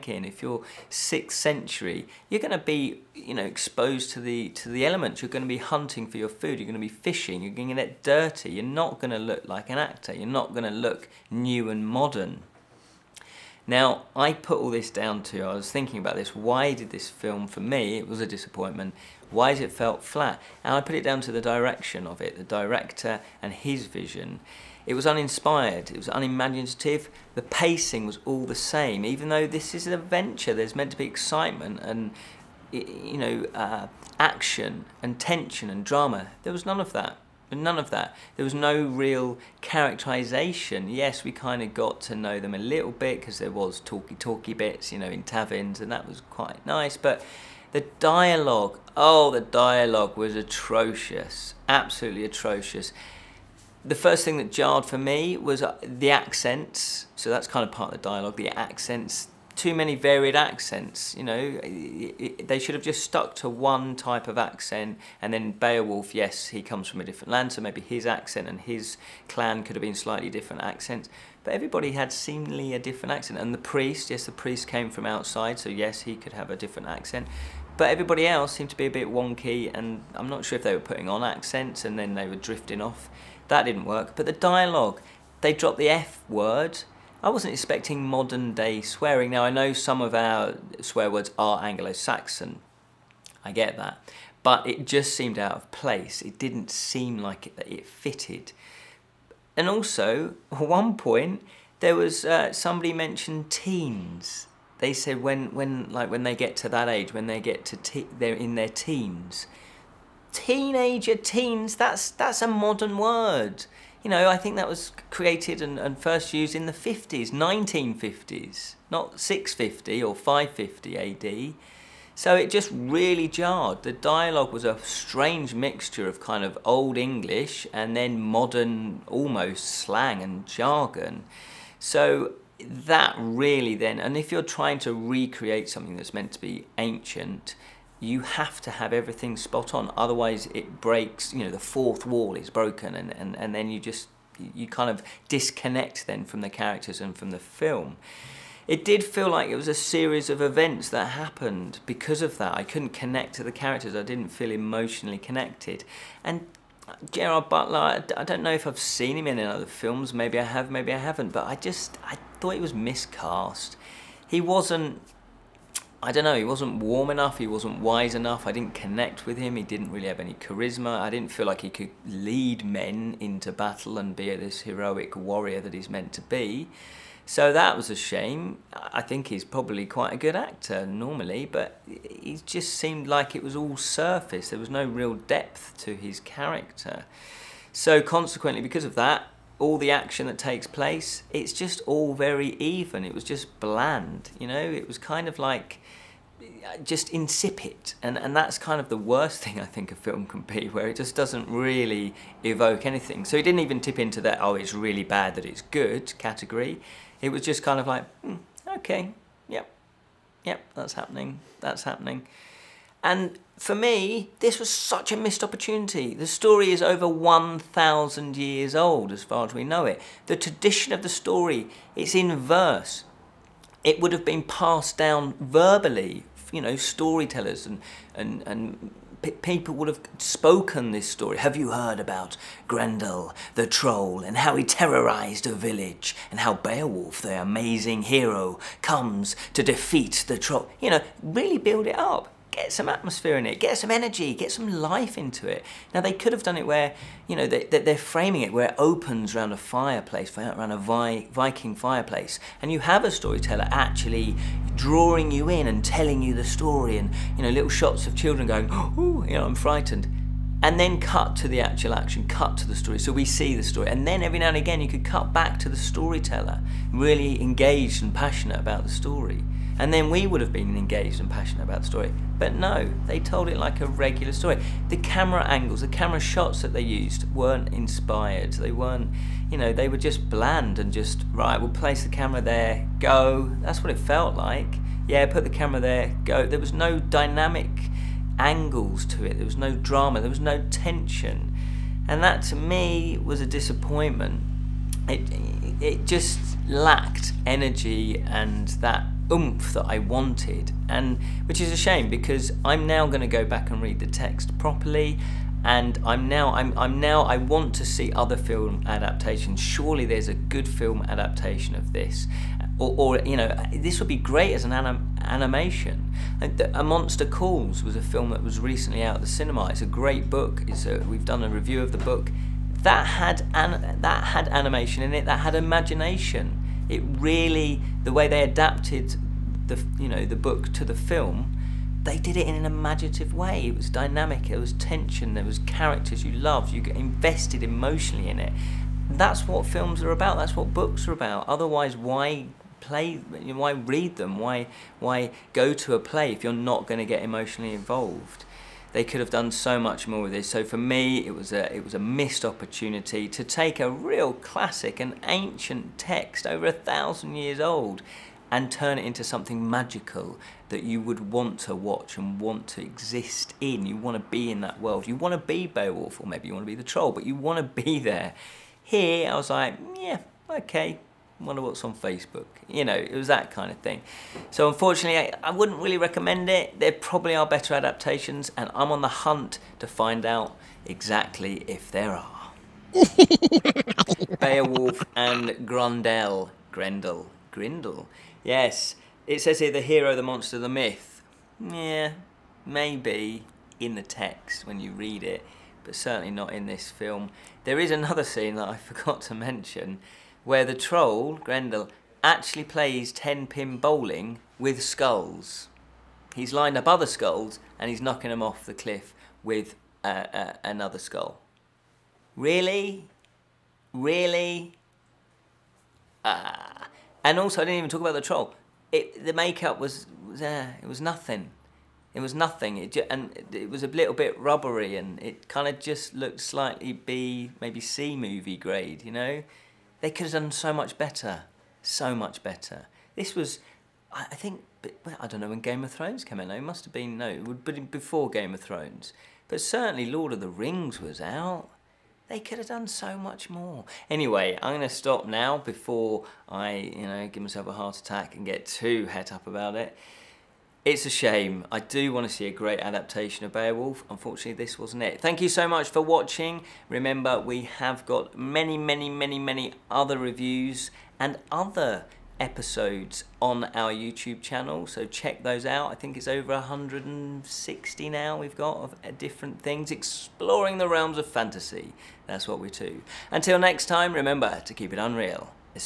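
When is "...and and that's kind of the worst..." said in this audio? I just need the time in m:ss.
3:18.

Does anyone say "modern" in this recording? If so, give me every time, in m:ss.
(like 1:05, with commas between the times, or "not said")
0:11, 1:28, 1:52, 2:08.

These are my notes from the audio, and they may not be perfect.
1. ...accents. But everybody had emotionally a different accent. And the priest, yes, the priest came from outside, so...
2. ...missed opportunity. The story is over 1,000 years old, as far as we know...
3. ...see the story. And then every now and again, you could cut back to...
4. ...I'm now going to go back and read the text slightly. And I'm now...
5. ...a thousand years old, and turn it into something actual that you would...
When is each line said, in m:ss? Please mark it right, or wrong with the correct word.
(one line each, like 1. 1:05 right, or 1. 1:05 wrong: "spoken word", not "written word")
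1. 1:10 wrong: "seemingly", not "emotionally"
2. 3:35 right
3. 4:23 right
4. 5:02 wrong: "properly", not "slightly"
5. 5:56 wrong: "magical", not "actual".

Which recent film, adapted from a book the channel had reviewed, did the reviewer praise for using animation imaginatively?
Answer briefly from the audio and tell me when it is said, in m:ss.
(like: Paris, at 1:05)
A Monster Calls, at 5:16.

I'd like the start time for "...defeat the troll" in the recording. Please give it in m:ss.
3:59.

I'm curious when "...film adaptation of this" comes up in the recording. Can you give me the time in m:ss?
5:10.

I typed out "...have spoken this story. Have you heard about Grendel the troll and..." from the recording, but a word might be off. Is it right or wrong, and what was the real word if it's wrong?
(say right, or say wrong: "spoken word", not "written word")
right.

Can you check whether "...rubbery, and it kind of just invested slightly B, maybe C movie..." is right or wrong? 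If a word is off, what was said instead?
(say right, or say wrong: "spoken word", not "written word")
wrong: "looked", not "invested".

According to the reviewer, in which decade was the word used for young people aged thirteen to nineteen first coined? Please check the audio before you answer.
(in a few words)
1950s.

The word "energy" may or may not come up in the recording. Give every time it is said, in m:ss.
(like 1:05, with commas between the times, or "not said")
4:03, 4:57.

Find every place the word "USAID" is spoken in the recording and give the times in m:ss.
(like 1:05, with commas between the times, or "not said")
not said.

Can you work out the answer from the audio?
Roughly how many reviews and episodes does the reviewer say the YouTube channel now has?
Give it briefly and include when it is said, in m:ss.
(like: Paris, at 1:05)
over 160, at 7:46.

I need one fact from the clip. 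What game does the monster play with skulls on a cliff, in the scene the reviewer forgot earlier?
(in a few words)
10 pin bowling.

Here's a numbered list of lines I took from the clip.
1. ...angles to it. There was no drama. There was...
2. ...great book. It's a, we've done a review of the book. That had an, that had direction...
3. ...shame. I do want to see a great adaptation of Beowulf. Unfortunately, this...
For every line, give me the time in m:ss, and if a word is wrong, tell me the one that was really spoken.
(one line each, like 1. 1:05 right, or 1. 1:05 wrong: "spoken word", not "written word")
1. 4:48 right
2. 5:19 wrong: "animation", not "direction"
3. 7:31 right.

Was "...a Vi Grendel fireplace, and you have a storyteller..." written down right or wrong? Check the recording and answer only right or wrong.
wrong.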